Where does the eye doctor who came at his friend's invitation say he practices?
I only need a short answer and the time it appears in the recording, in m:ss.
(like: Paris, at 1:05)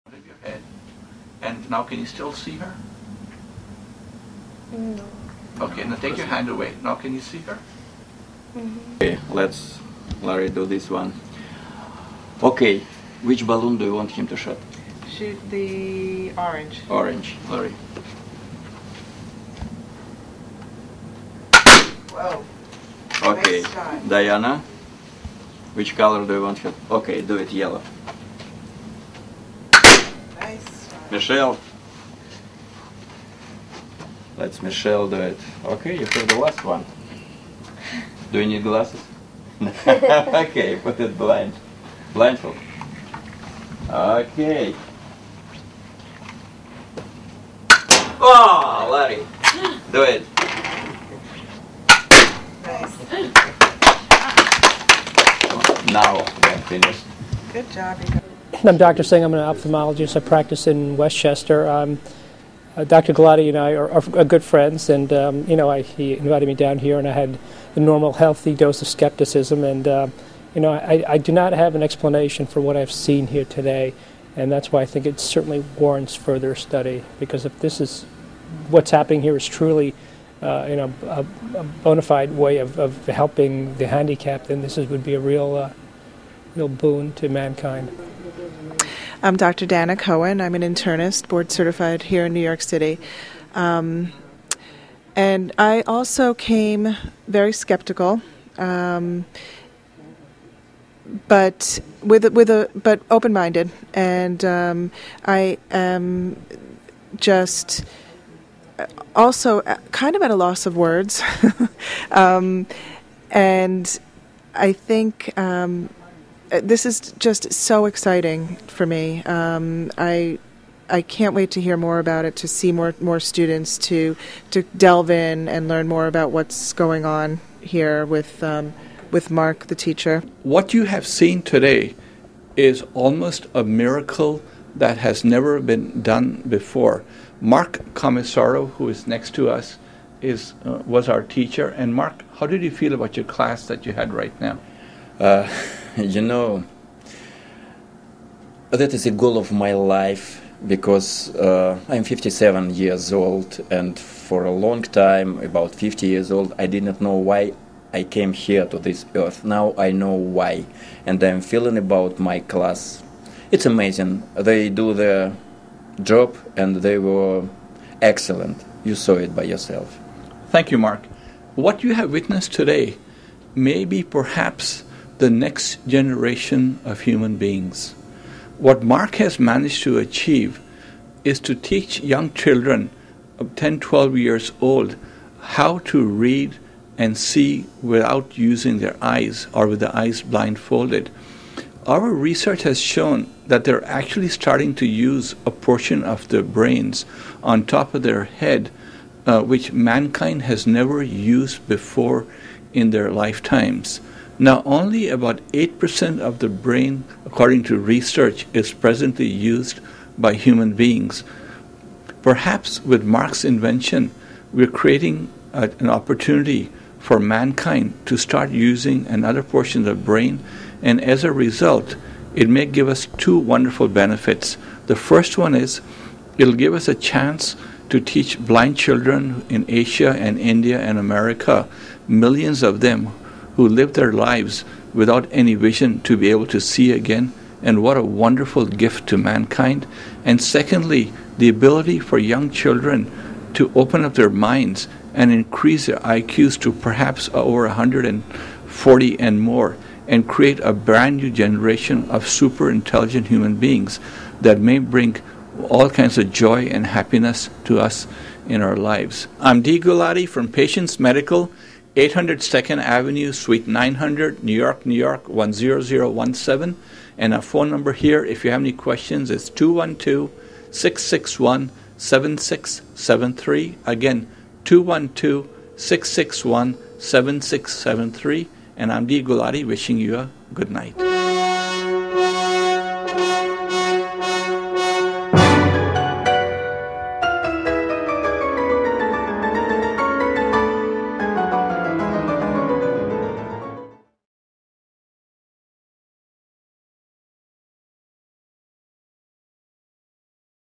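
Westchester, at 1:00.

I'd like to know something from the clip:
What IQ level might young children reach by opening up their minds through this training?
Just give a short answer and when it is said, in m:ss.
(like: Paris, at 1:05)
Over 140, at 4:07.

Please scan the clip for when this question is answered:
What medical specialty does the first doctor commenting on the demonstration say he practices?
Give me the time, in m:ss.
0:59.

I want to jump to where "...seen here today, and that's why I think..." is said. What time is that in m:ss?
1:12.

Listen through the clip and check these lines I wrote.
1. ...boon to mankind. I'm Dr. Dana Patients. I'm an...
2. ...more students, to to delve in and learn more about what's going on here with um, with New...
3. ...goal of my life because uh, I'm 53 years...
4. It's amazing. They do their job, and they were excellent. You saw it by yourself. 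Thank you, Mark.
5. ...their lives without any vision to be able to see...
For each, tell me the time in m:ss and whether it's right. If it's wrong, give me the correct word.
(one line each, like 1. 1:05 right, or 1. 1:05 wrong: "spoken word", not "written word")
1. 1:26 wrong: "Cohen", not "Patients"
2. 2:02 wrong: "Mark", not "New"
3. 2:29 wrong: "57", not "53"
4. 2:43 right
5. 3:53 right.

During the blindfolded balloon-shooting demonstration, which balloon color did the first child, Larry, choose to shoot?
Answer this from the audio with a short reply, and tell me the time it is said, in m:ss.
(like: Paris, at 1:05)
Orange, at 0:15.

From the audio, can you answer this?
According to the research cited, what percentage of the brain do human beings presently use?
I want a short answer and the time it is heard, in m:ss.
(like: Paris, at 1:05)
8%, at 3:25.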